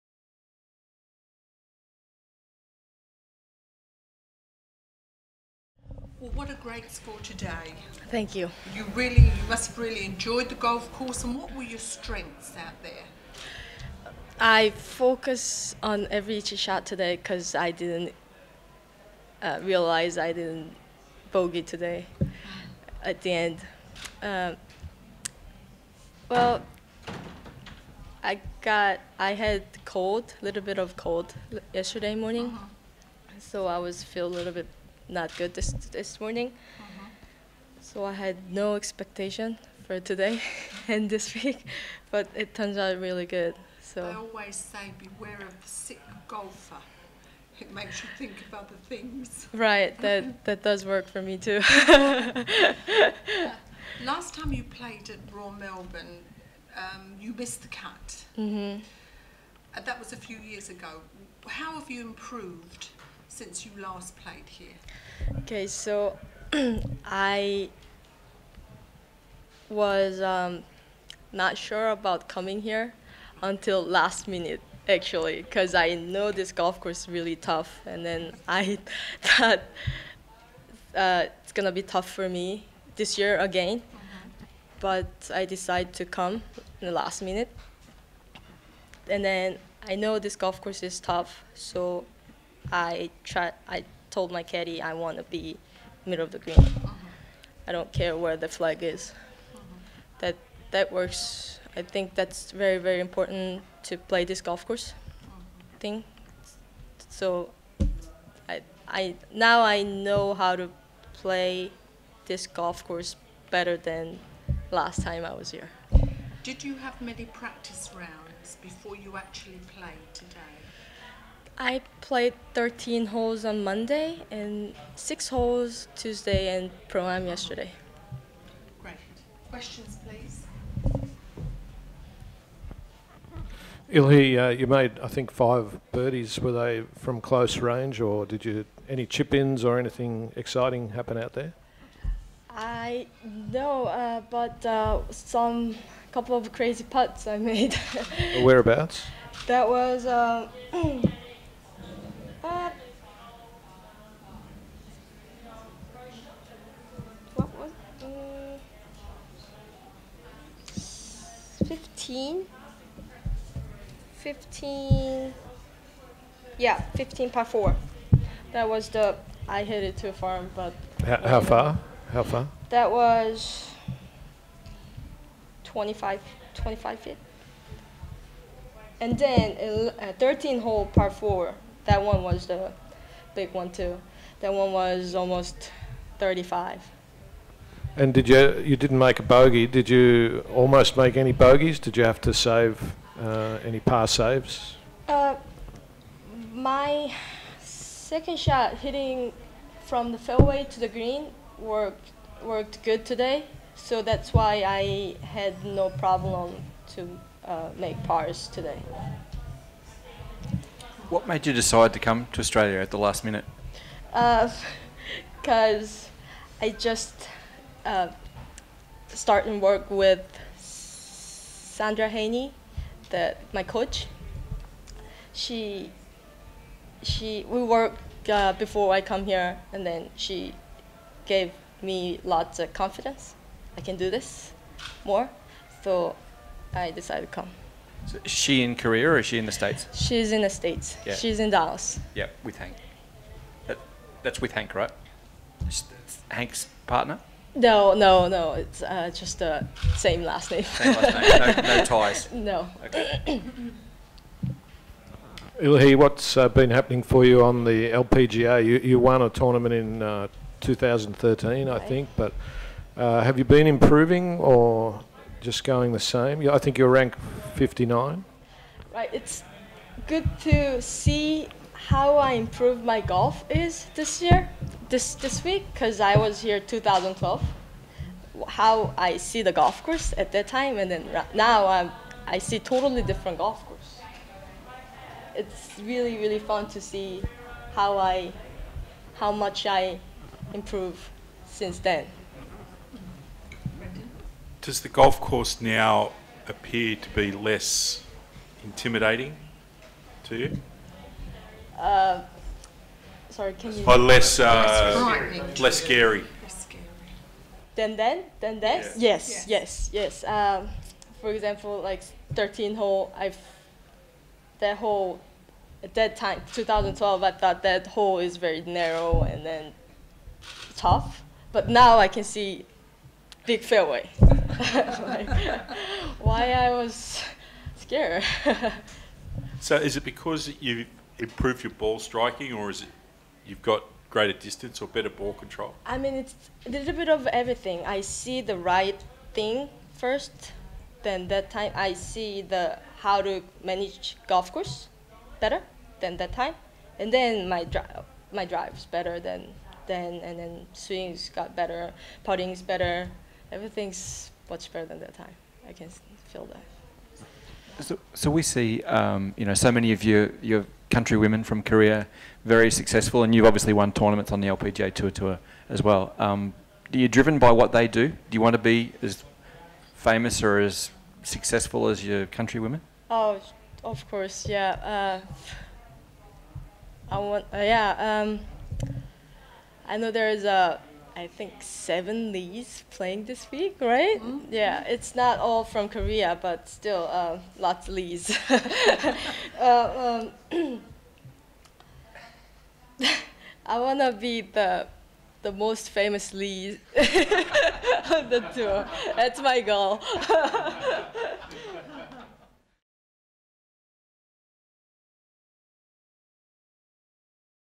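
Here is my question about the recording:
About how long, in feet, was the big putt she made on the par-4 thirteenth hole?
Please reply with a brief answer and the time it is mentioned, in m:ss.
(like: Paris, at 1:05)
35, at 3:05.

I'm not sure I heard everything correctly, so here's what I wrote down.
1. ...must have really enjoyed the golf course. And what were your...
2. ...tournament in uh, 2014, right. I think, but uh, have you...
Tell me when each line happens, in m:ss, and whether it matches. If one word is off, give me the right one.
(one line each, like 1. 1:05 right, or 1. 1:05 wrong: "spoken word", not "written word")
1. 0:09 right
2. 4:19 wrong: "2013", not "2014".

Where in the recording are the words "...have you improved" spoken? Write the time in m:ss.
1:01.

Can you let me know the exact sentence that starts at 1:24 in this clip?
but I decided to come in the last minute and then I know this golf course is tough so I try.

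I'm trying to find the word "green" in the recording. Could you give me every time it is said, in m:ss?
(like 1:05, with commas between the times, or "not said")
1:36, 3:20.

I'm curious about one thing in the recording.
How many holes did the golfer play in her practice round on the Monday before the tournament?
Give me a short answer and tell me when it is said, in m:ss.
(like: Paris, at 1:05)
13, at 2:02.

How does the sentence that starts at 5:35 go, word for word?
I mean, it's a little bit of everything.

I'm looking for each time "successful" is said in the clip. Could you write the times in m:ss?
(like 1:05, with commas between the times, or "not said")
6:02, 6:11.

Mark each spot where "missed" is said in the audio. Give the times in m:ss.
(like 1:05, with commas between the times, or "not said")
0:57.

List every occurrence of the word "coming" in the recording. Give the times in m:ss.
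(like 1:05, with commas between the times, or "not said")
1:12.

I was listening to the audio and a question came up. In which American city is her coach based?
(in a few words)
Dallas.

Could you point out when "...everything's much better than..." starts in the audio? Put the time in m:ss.
5:53.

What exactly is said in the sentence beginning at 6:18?
Um, I know there is a I think seven Lees playing this week, right?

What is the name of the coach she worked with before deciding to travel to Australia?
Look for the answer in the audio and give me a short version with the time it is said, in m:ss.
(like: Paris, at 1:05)
Sandra Haynie, at 3:40.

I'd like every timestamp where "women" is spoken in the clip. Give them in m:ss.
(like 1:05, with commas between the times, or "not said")
6:01, 6:12.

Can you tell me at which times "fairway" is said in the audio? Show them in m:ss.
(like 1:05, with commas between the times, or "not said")
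3:20, 5:23.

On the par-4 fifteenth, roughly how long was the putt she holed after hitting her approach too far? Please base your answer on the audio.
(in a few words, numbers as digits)
25 feet.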